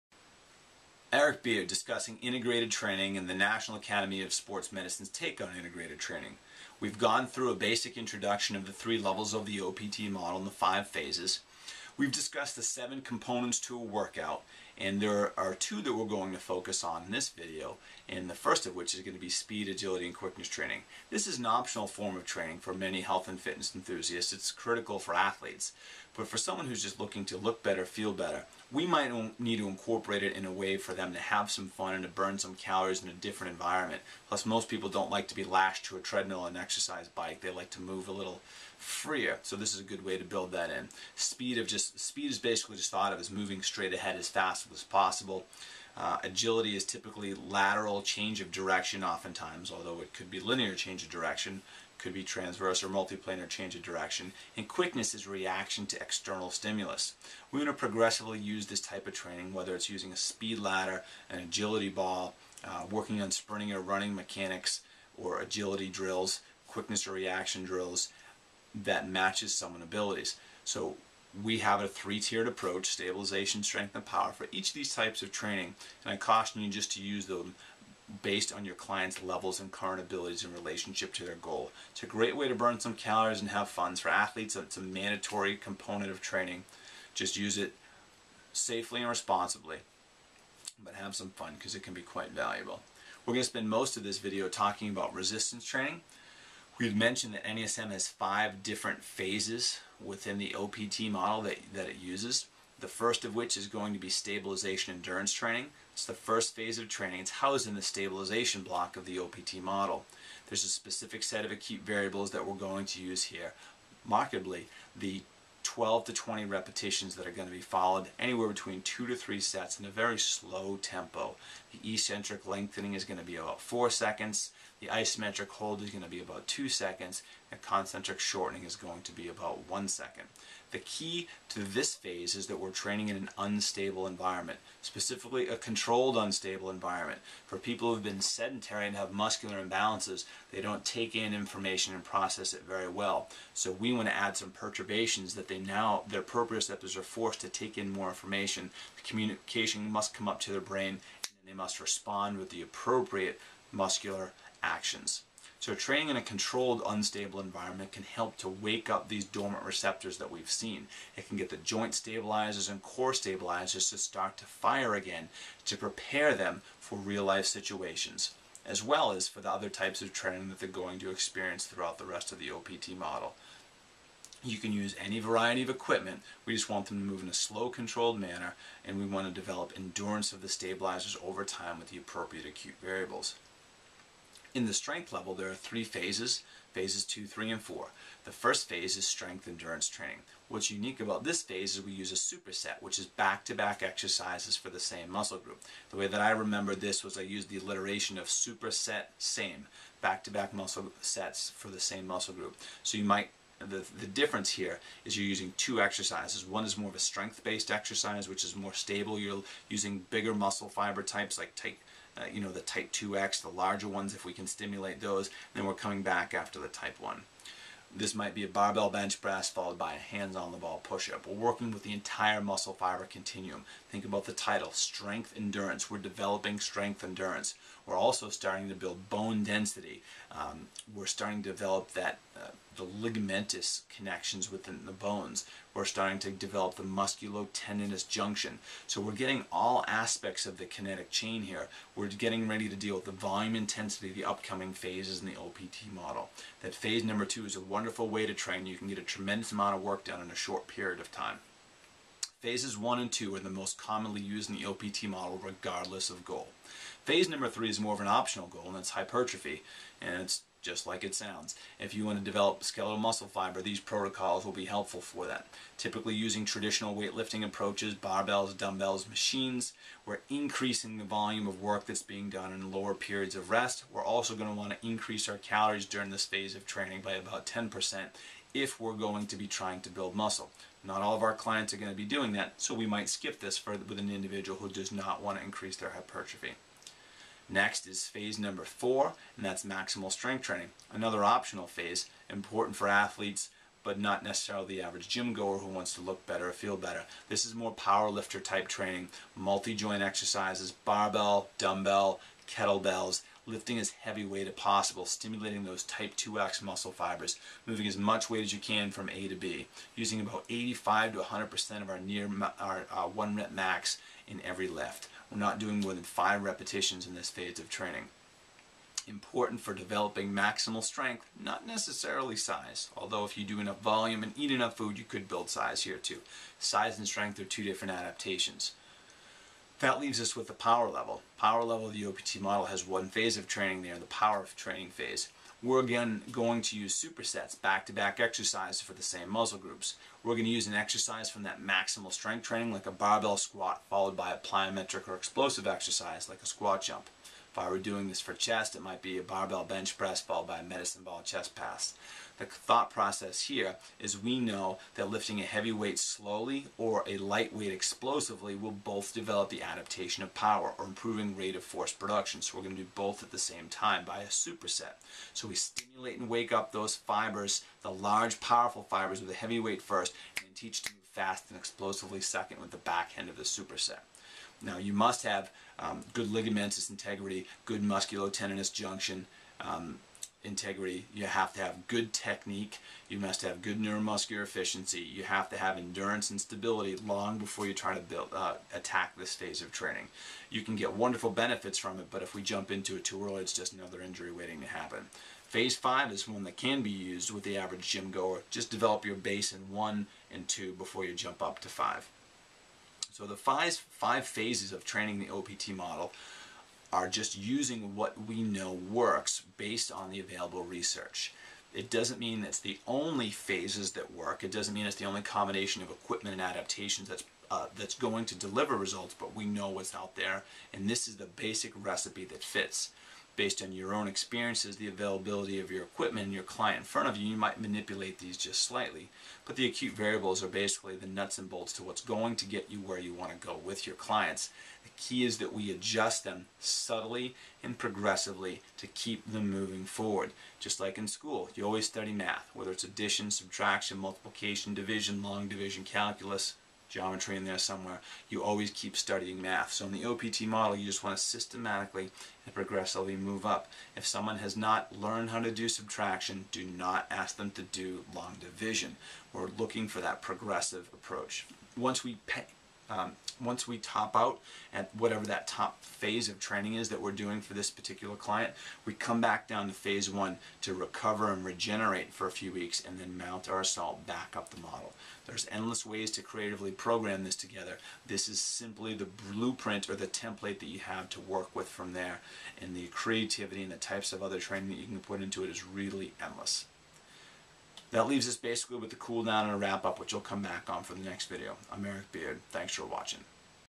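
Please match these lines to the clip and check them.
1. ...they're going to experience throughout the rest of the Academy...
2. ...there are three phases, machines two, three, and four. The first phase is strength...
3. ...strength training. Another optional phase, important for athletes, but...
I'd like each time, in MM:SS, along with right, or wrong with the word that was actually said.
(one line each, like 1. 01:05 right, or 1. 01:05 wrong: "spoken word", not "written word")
1. 02:50 wrong: "OPT", not "Academy"
2. 03:05 wrong: "phases", not "machines"
3. 04:50 right.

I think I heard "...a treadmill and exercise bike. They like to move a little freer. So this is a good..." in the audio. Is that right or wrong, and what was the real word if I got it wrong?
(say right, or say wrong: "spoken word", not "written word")
right.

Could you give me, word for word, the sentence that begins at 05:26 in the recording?
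Size and strength are two different adaptations.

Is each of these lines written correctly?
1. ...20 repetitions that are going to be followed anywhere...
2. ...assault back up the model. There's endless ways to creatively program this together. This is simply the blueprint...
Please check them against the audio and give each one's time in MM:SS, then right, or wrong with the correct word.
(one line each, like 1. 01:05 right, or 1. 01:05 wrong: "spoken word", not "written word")
1. 01:56 right
2. 07:53 right.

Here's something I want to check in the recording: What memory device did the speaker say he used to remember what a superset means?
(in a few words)
Alliteration.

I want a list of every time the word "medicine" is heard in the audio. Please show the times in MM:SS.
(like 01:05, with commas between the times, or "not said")
00:04, 05:50.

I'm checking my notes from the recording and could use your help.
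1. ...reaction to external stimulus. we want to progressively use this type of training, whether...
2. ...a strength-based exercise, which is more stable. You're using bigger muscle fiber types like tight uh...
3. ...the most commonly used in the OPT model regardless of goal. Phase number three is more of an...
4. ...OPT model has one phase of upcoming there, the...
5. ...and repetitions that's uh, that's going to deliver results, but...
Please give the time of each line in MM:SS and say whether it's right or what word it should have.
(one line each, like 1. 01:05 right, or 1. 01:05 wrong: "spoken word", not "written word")
1. 00:55 right
2. 03:26 right
3. 04:13 right
4. 05:32 wrong: "training", not "upcoming"
5. 06:56 wrong: "adaptations", not "repetitions".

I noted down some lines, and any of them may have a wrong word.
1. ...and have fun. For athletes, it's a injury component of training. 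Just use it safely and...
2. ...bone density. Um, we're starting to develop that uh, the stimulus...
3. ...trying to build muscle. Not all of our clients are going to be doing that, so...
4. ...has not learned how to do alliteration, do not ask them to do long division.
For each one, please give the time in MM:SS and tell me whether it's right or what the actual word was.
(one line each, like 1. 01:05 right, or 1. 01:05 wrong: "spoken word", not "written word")
1. 01:23 wrong: "mandatory", not "injury"
2. 03:49 wrong: "ligamentous", not "stimulus"
3. 04:39 right
4. 07:34 wrong: "subtraction", not "alliteration".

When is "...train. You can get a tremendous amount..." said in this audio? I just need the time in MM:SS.
04:08.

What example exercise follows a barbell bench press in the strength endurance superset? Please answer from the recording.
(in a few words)
Hands on the ball push up.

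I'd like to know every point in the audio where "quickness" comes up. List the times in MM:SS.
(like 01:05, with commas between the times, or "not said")
00:20, 00:54, 01:06.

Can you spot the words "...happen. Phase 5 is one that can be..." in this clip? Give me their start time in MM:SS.
06:34.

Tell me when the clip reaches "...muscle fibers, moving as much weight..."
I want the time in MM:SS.
05:06.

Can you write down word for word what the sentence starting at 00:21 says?
This is an optional form of training for many health and fitness enthusiasts.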